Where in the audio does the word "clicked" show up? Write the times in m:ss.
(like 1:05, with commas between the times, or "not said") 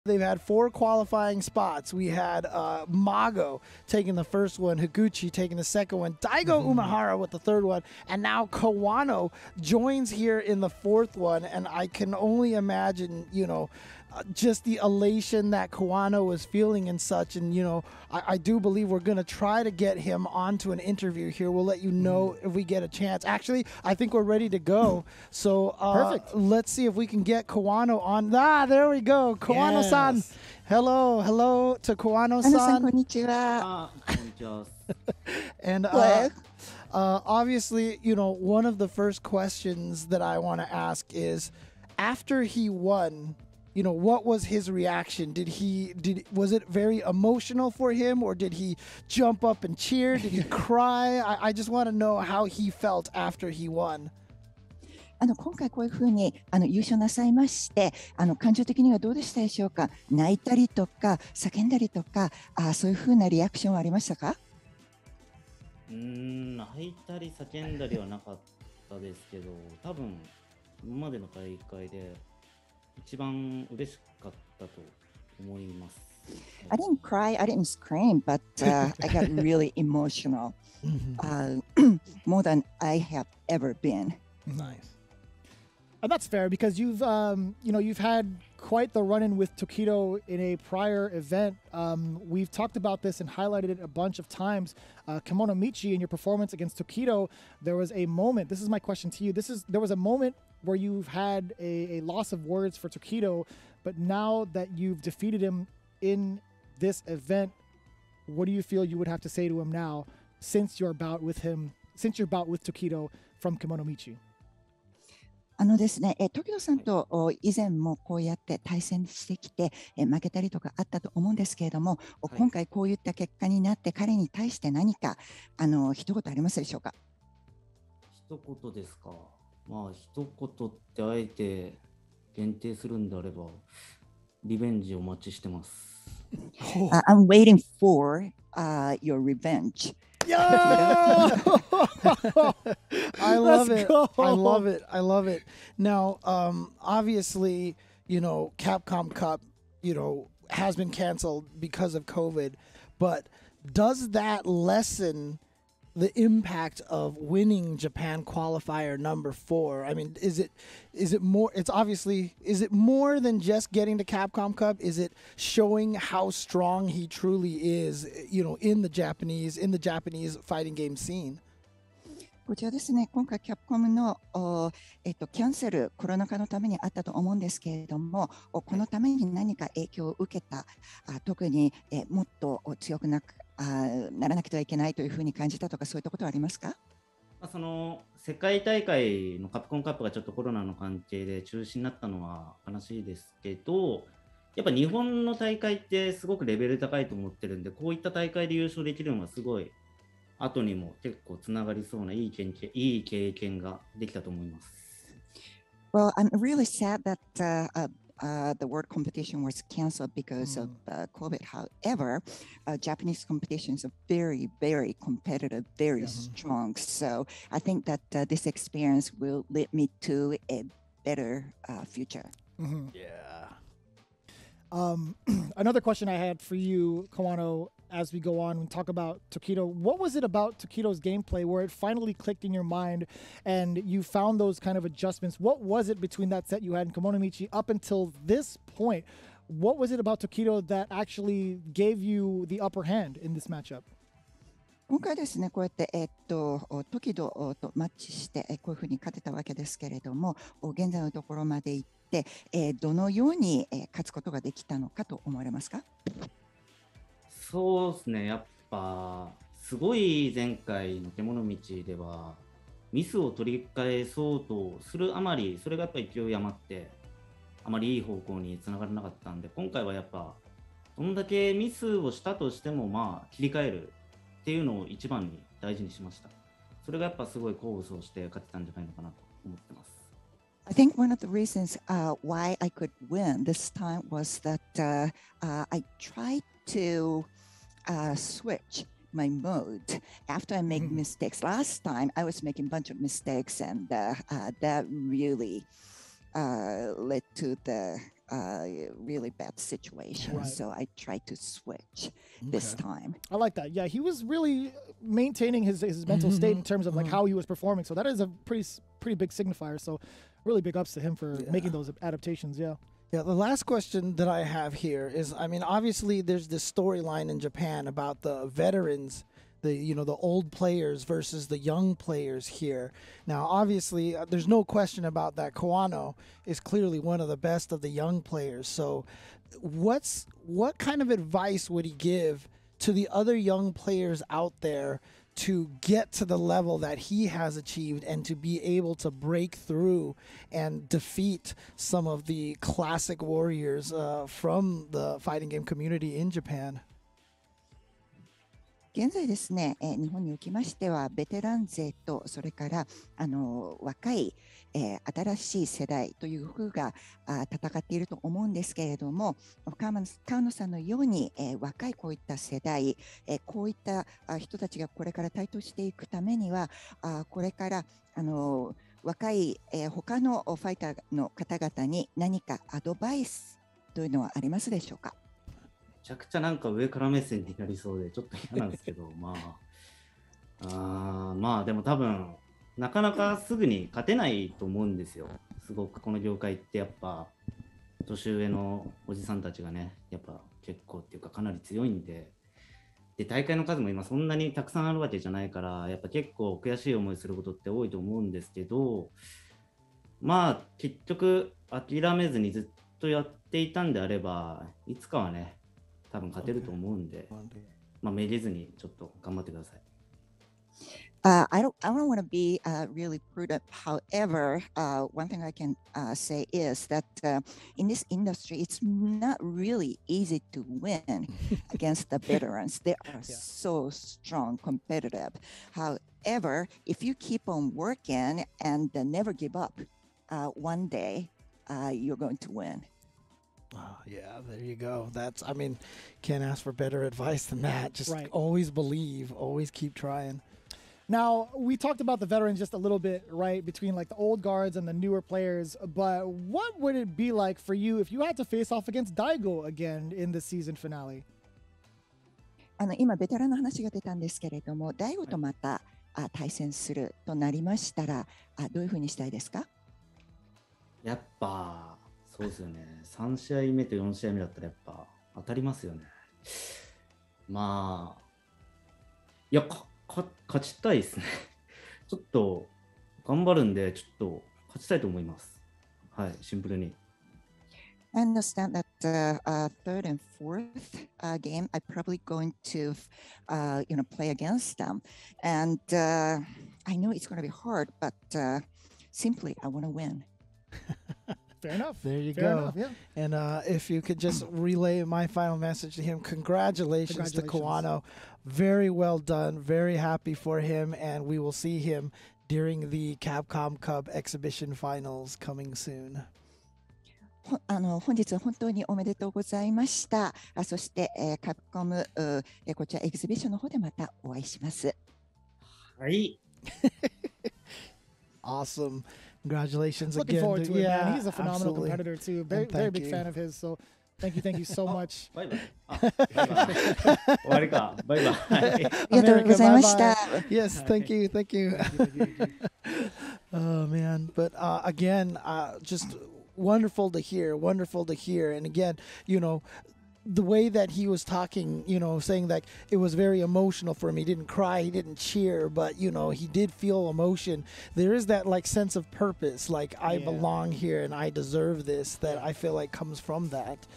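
3:52.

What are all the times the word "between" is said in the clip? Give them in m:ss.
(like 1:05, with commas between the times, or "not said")
3:55, 7:23.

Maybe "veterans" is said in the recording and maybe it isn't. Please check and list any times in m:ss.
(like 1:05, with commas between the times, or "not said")
5:18, 7:02, 7:22.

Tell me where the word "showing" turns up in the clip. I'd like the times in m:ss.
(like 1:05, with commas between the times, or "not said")
2:45.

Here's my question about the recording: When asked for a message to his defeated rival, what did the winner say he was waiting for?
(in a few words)
Revenge.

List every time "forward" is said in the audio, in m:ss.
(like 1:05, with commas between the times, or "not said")
8:40.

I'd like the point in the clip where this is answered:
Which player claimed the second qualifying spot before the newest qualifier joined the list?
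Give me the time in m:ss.
0:04.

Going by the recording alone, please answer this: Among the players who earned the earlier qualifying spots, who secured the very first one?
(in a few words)
Mago.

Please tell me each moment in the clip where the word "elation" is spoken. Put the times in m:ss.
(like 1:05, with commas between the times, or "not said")
0:14.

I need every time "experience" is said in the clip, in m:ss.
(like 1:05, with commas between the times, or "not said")
3:38.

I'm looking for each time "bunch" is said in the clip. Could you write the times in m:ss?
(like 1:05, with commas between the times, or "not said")
1:33, 4:52.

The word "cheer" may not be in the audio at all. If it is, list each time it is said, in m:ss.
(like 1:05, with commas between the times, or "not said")
0:49, 9:05.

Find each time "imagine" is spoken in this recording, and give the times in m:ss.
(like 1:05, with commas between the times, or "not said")
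0:12.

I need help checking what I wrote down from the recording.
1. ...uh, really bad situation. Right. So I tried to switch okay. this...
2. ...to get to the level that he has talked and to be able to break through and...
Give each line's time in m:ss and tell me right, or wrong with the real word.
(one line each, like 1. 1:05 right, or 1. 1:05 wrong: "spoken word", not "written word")
1. 4:58 right
2. 5:35 wrong: "achieved", not "talked".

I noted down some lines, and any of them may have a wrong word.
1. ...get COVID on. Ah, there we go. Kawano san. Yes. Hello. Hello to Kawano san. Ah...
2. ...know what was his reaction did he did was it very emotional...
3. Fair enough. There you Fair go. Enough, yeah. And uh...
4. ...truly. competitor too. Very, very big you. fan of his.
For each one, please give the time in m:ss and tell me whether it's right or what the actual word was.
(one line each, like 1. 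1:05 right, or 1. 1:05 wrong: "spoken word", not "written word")
1. 0:27 wrong: "Kawano", not "COVID"
2. 0:43 right
3. 8:11 right
4. 8:41 wrong: "absolutely", not "truly".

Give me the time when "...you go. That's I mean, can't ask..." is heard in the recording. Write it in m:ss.
7:14.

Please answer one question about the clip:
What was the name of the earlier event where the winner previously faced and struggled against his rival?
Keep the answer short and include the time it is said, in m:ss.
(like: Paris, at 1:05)
Kemonomichi, at 3:56.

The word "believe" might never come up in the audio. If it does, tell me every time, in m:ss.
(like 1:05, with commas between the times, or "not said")
0:18, 7:18.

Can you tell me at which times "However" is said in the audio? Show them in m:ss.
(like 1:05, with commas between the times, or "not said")
3:31, 6:53, 7:05.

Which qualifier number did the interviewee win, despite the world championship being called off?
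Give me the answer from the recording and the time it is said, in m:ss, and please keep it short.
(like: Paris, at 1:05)
Japan qualifier number 4, at 2:37.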